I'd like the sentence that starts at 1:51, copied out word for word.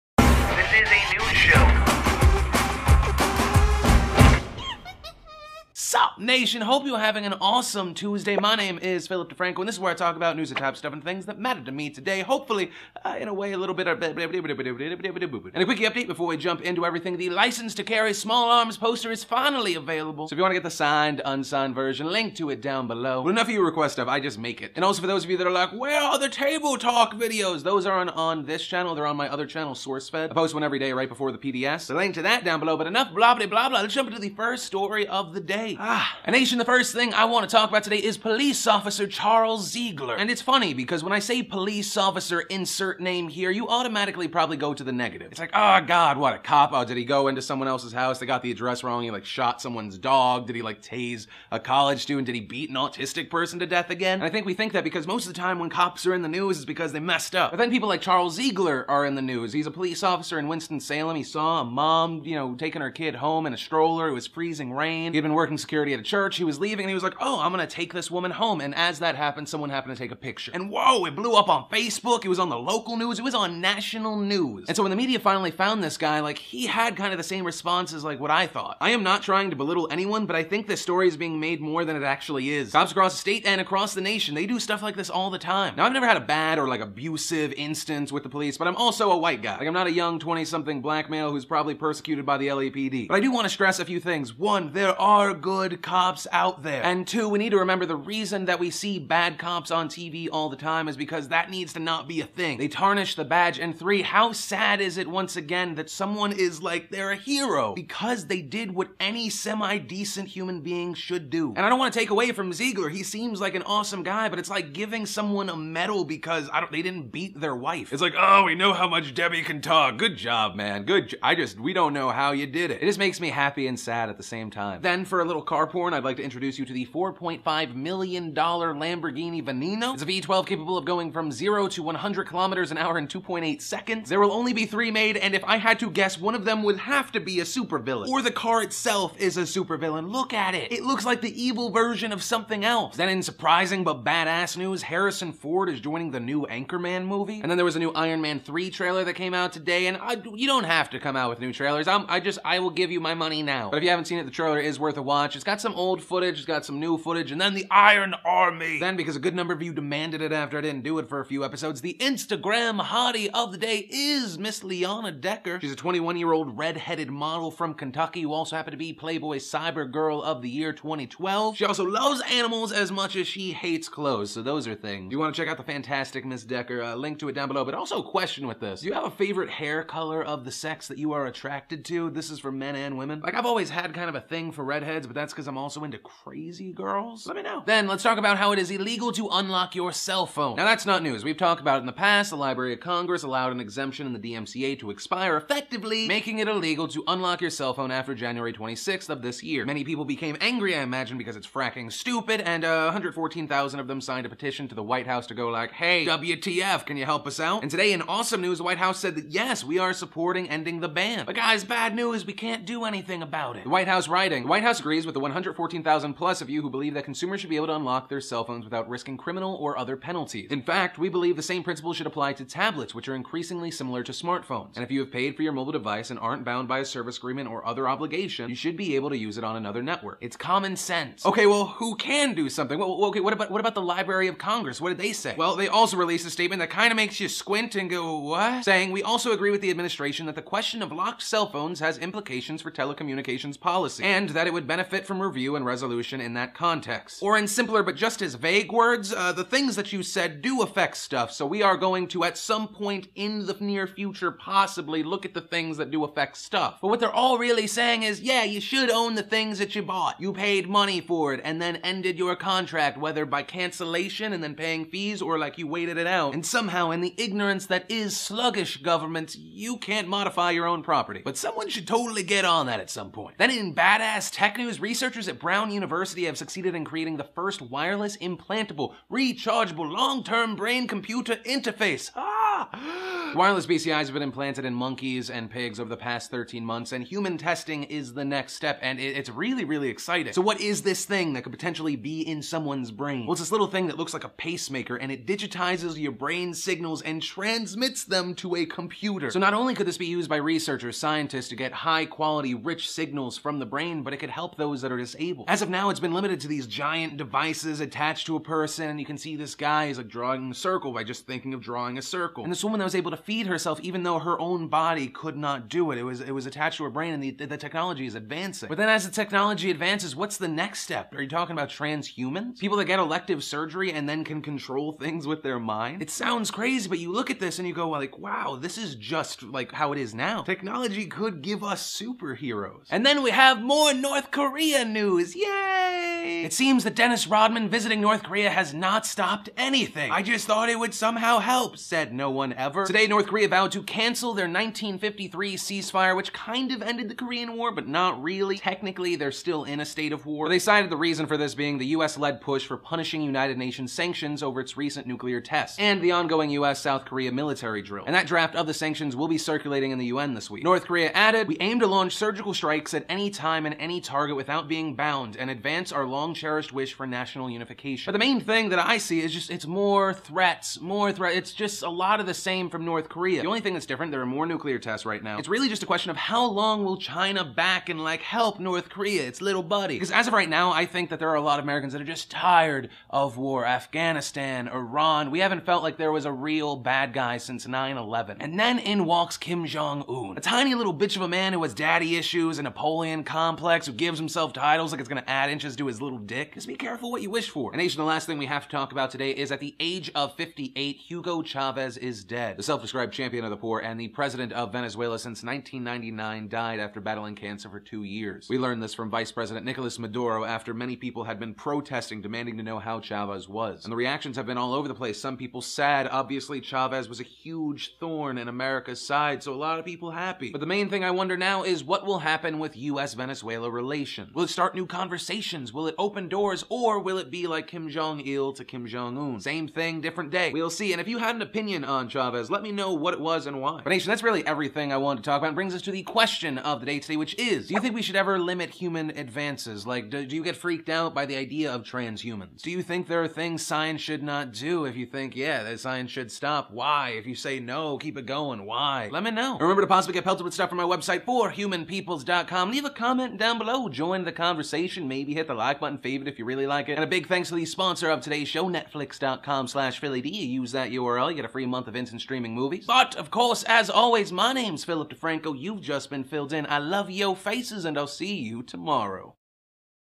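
And I don't want to take away from Ziegler.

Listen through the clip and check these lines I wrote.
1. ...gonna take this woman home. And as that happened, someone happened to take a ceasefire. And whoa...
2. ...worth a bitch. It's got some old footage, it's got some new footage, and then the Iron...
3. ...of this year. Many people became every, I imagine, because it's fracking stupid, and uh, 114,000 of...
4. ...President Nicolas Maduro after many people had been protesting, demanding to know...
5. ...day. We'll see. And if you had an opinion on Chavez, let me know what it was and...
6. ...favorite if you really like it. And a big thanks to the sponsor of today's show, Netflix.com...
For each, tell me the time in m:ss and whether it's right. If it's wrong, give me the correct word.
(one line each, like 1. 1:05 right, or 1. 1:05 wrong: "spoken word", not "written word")
1. 1:07 wrong: "picture", not "ceasefire"
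2. 2:34 wrong: "watch", not "bitch"
3. 3:19 wrong: "angry", not "every"
4. 6:49 right
5. 7:10 right
6. 7:36 right.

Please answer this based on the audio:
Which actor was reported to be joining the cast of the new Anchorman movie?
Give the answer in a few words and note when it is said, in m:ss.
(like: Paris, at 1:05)
Harrison Ford, at 2:24.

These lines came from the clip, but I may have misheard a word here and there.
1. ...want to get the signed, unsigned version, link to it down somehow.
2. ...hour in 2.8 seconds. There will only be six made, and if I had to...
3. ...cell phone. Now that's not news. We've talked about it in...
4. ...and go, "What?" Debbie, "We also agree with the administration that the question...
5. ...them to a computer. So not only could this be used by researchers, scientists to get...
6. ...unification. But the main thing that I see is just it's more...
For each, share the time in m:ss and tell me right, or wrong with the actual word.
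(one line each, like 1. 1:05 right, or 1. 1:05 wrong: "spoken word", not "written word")
1. 0:20 wrong: "below", not "somehow"
2. 2:12 wrong: "three", not "six"
3. 3:09 right
4. 3:57 wrong: "Saying", not "Debbie"
5. 4:58 right
6. 6:07 right.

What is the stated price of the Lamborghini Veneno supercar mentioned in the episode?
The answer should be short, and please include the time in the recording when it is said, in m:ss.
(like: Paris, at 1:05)
$4.5 million, at 2:06.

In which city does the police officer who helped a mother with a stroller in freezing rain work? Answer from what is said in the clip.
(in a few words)
Winston-Salem.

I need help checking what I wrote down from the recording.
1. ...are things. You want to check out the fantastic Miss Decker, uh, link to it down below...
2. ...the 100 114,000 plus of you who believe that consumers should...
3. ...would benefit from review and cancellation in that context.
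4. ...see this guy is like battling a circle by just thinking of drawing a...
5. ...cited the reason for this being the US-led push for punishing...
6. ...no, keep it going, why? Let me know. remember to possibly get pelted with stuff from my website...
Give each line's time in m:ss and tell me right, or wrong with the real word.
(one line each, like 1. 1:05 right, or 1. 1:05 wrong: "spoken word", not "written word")
1. 2:54 right
2. 3:35 right
3. 4:04 wrong: "resolution", not "cancellation"
4. 5:09 wrong: "drawing", not "battling"
5. 5:50 right
6. 7:27 right.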